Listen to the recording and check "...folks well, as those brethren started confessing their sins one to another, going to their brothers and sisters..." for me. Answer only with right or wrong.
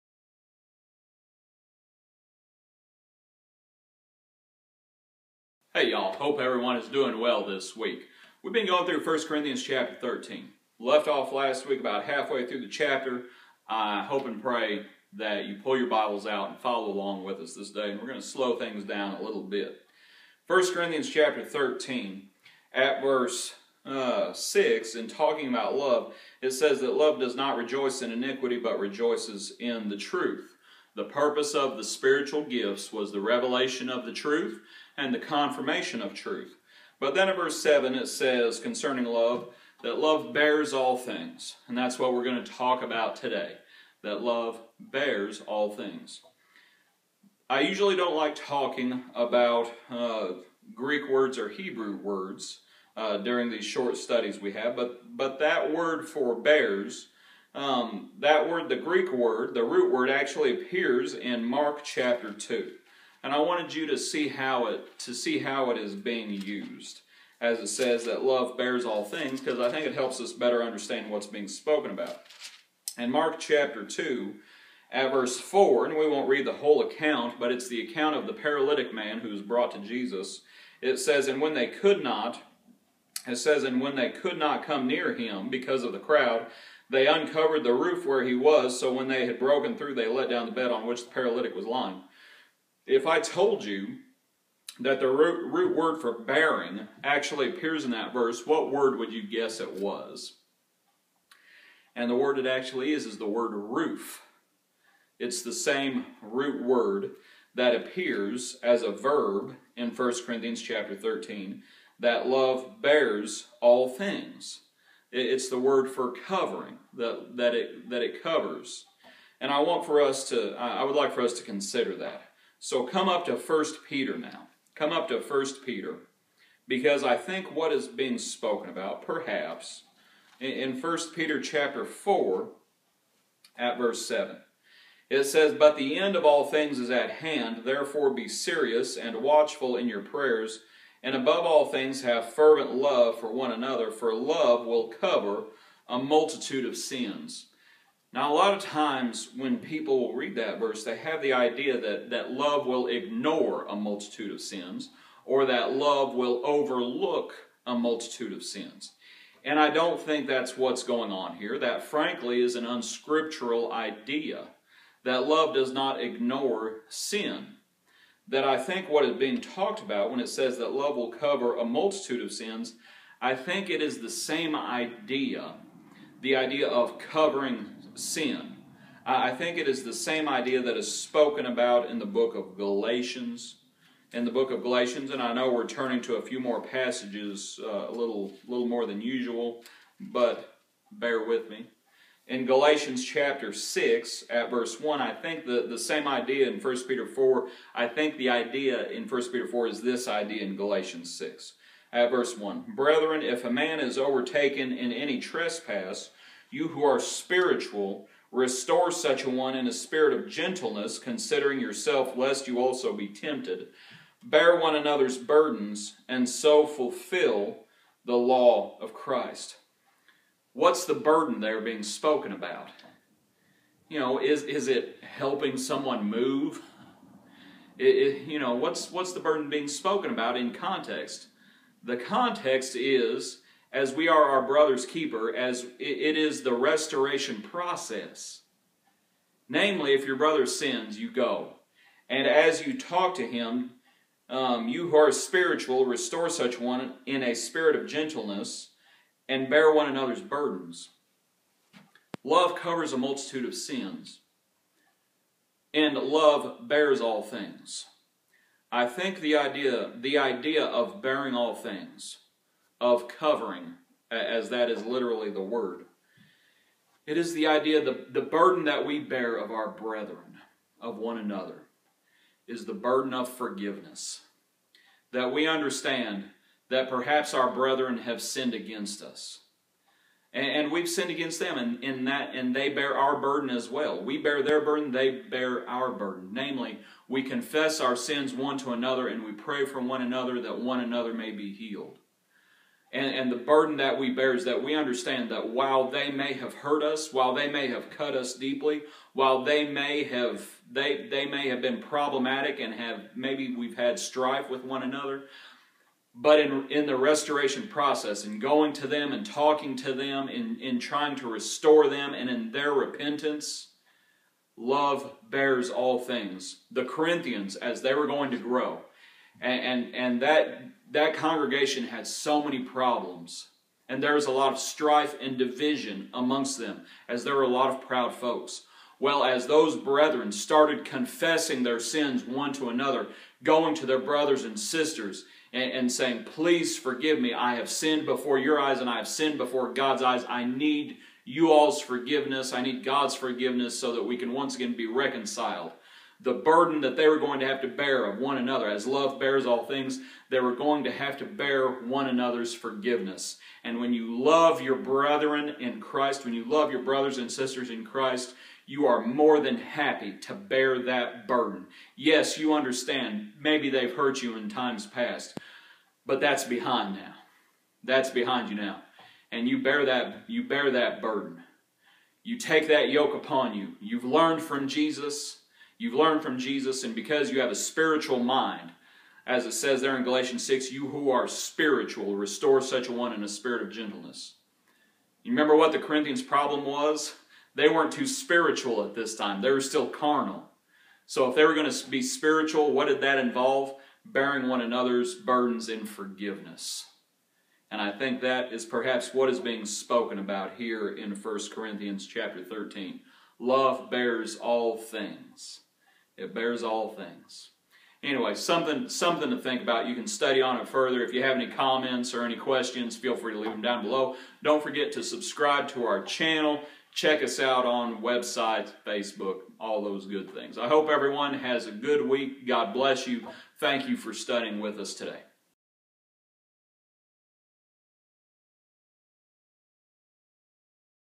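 right.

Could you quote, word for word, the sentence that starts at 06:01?
Yes, you understand, maybe they've hurt you in times past, but that's behind now.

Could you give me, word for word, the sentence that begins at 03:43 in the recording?
You know, is, is it helping someone move?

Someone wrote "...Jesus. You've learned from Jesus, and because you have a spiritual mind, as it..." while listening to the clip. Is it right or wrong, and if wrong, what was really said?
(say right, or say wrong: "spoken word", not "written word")
right.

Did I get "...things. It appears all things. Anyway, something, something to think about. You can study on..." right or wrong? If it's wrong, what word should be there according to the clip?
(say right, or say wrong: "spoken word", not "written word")
wrong: "bears", not "appears".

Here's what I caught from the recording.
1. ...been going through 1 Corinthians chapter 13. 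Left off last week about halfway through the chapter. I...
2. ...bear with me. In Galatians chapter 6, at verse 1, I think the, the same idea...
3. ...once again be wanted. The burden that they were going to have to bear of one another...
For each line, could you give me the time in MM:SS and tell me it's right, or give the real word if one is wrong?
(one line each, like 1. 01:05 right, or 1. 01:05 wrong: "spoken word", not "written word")
1. 00:08 right
2. 03:10 right
3. 05:44 wrong: "reconciled", not "wanted".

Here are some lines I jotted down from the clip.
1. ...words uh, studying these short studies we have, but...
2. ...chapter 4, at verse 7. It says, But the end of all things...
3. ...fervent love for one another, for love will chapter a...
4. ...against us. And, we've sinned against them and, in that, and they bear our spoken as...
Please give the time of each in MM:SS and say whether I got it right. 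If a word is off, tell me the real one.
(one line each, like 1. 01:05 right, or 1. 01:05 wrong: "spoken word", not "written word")
1. 00:51 wrong: "during", not "studying"
2. 02:11 right
3. 02:22 wrong: "cover", not "chapter"
4. 04:38 wrong: "burden", not "spoken".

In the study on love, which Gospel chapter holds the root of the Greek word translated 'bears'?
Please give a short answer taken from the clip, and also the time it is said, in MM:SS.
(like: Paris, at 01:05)
Mark 2, at 01:01.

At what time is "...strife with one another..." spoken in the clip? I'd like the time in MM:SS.
05:03.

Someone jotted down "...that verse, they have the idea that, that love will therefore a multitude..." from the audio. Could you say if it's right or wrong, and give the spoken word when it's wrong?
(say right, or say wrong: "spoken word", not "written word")
wrong: "ignore", not "therefore".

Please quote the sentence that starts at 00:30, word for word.
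The purpose of the spiritual gifts was the revelation of the truth and the confirmation of truth.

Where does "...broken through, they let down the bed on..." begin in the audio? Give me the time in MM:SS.
01:29.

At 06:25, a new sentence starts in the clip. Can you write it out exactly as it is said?
You remember what the Corinthians' problem was?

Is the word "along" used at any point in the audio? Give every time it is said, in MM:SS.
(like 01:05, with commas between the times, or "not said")
00:16.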